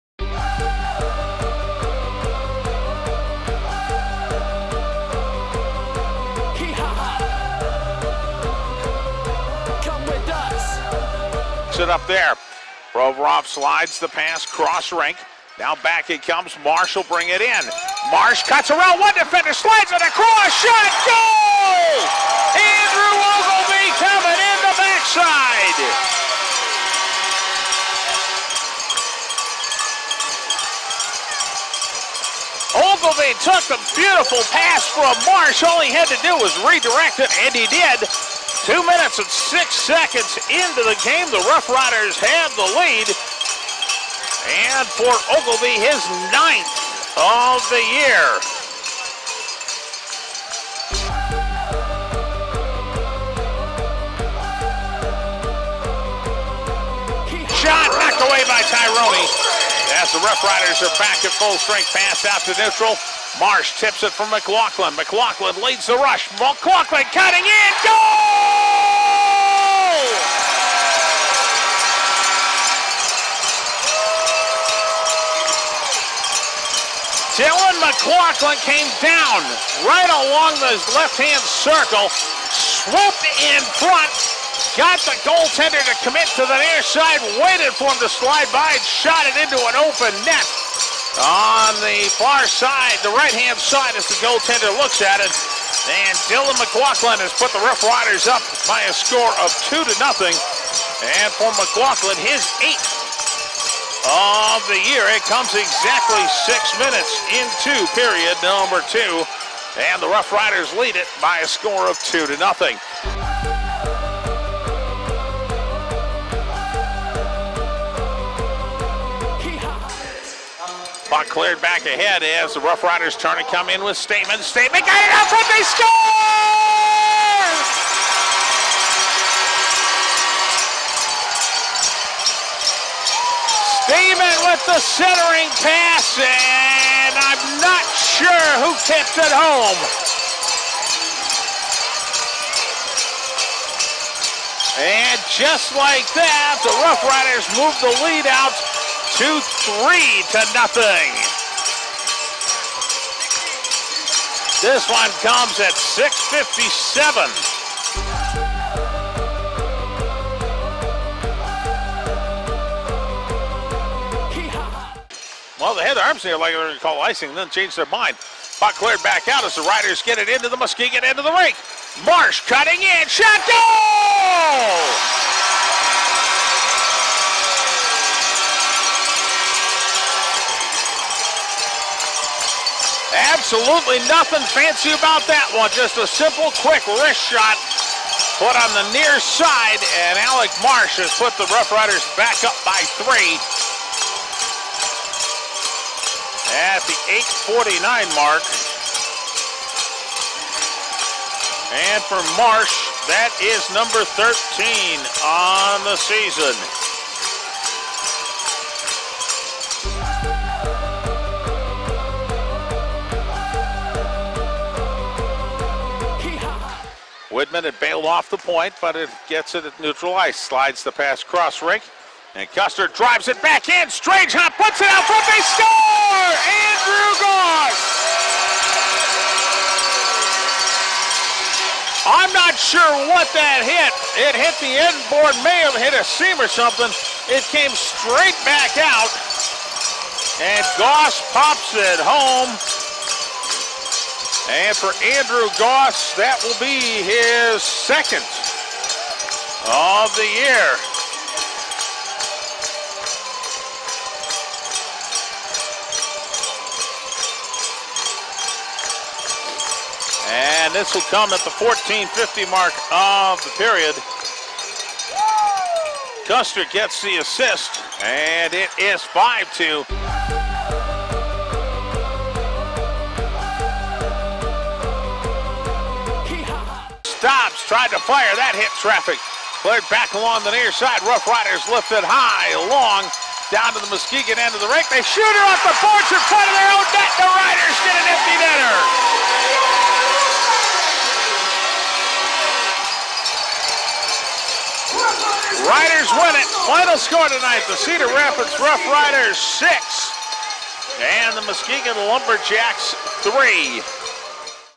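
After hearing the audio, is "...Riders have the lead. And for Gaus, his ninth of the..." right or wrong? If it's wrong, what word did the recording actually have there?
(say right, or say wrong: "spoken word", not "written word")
wrong: "Oglevie", not "Gaus".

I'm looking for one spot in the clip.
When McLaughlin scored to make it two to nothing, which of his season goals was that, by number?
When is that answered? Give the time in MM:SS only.
01:42.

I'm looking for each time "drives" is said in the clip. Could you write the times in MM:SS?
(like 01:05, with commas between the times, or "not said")
03:42.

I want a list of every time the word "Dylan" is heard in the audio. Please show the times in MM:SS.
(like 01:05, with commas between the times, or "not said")
01:17, 01:36.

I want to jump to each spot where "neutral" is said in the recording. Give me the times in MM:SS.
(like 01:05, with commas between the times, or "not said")
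01:02, 03:39.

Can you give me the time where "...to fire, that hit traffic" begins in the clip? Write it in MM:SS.
04:37.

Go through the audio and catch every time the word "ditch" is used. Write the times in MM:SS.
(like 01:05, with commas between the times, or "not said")
not said.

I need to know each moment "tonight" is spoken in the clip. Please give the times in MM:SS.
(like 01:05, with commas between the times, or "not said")
04:57.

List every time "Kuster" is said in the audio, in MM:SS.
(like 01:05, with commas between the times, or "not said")
03:42, 04:26.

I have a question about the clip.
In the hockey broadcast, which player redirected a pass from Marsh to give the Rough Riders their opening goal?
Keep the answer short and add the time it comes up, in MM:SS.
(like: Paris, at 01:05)
Andrew Oglevie, at 00:22.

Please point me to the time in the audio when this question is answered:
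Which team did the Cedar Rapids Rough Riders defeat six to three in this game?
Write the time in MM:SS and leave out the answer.
05:01.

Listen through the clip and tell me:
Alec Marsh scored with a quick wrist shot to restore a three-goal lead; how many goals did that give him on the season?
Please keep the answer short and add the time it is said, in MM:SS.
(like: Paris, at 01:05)
13, at 03:23.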